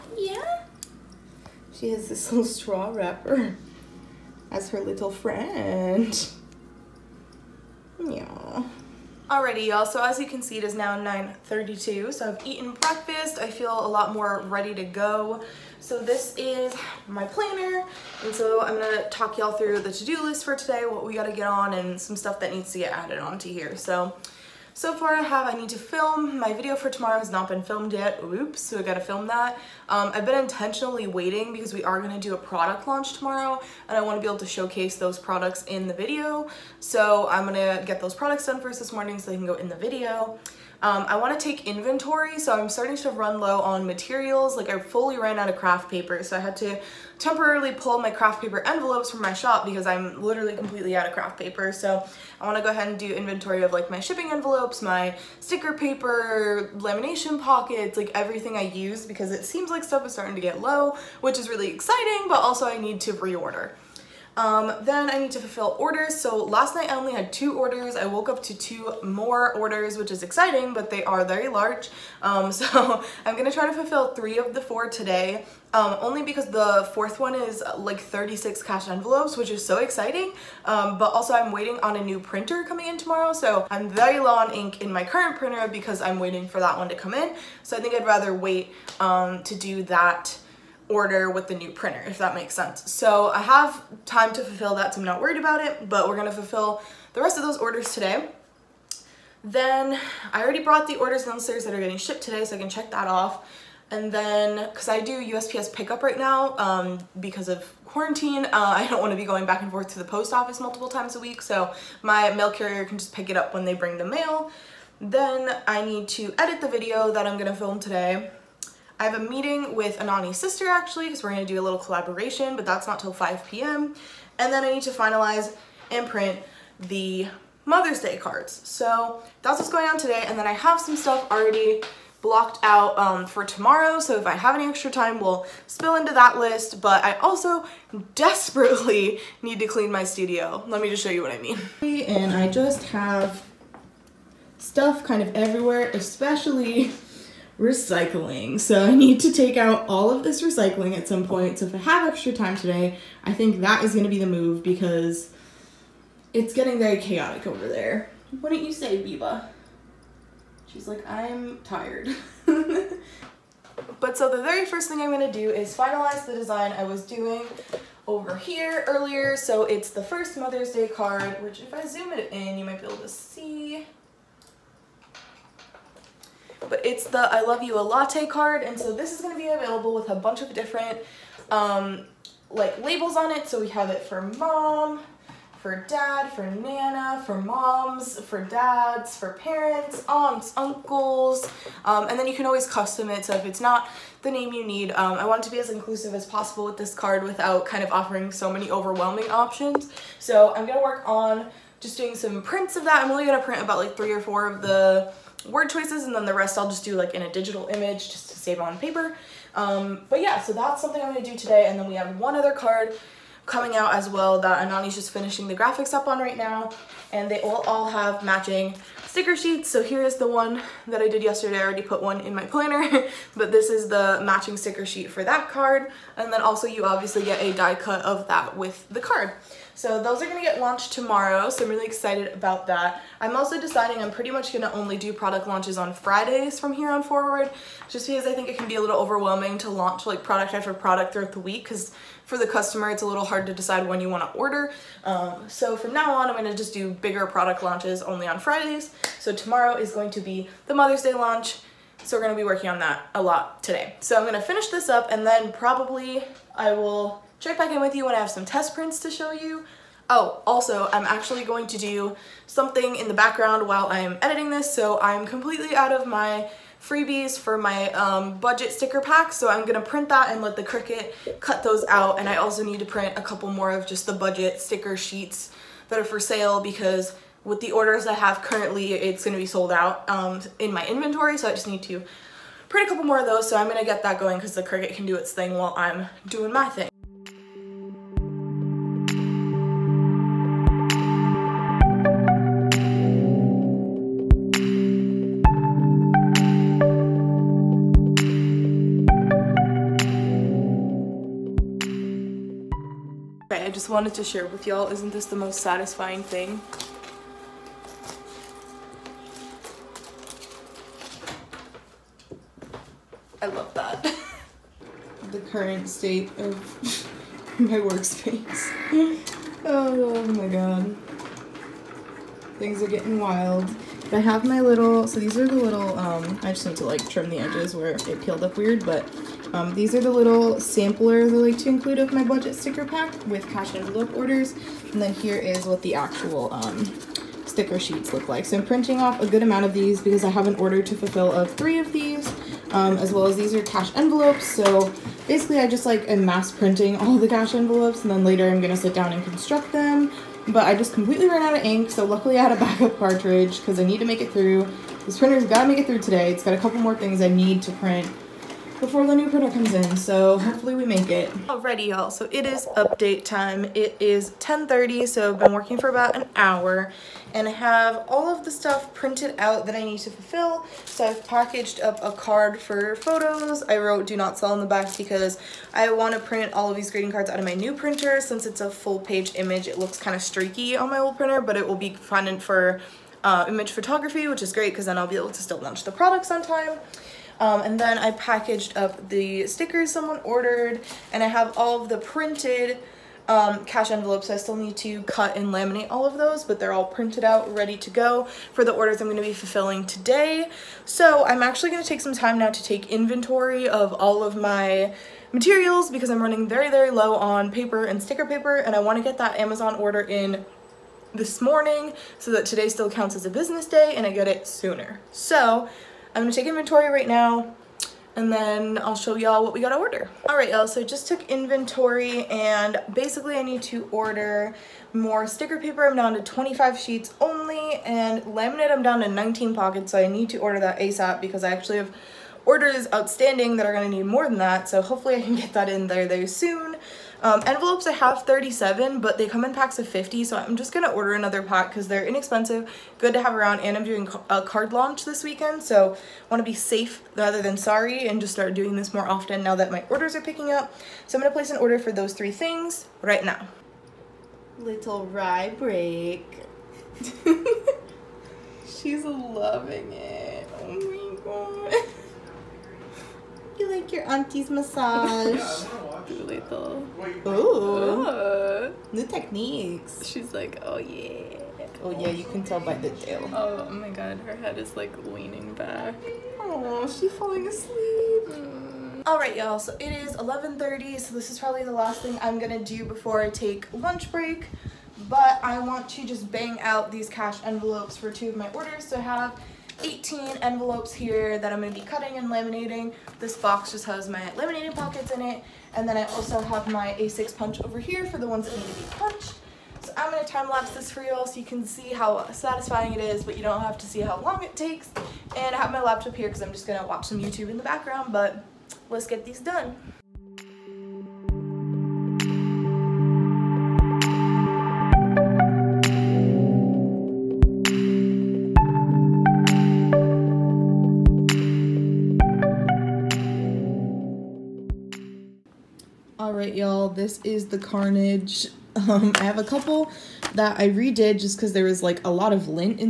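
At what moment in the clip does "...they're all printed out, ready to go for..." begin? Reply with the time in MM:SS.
06:36.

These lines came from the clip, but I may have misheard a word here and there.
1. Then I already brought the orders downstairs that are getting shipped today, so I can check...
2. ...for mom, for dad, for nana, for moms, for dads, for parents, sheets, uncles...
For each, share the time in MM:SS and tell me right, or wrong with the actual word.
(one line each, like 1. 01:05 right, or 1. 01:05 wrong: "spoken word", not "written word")
1. 01:39 right
2. 03:04 wrong: "aunts", not "sheets".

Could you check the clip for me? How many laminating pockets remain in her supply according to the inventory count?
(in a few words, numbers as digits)
19.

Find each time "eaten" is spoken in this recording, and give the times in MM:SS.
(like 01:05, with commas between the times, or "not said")
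00:12.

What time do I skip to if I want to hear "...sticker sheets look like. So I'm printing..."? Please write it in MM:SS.
05:37.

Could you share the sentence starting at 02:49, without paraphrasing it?
So it's the first Mother's Day card, which if I zoom it in, you might be able to see.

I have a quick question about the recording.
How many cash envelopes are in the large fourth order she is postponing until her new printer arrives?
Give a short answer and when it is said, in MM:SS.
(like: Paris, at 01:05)
36, at 01:17.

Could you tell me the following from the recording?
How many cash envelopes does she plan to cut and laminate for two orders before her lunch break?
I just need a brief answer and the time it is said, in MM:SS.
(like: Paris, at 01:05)
18, at 08:09.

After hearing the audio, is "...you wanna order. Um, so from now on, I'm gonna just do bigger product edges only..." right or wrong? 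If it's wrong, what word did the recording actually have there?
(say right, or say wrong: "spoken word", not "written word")
wrong: "launches", not "edges".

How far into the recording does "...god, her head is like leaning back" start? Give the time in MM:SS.
07:53.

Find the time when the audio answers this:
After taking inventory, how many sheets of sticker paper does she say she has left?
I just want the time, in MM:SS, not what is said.
07:06.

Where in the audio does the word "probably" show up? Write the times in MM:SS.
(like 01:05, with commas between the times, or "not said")
04:15, 08:01.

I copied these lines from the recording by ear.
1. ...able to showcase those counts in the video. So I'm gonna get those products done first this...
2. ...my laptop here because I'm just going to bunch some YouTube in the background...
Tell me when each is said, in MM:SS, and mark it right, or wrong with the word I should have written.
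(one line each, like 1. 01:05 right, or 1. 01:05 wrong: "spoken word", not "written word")
1. 00:34 wrong: "products", not "counts"
2. 08:25 wrong: "watch", not "bunch".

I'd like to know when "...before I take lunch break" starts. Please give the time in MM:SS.
08:02.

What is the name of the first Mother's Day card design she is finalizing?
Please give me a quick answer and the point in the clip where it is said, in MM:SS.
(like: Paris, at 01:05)
I Love You a Latte, at 02:57.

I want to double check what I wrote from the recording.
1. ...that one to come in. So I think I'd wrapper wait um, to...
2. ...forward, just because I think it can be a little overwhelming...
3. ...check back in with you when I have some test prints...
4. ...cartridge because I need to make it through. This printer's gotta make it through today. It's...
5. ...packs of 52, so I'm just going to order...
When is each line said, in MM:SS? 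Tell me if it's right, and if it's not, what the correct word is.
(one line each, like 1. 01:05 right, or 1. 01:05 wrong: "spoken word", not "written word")
1. 01:26 wrong: "rather", not "wrapper"
2. 03:57 right
3. 04:17 right
4. 05:52 right
5. 07:19 wrong: "50", not "52".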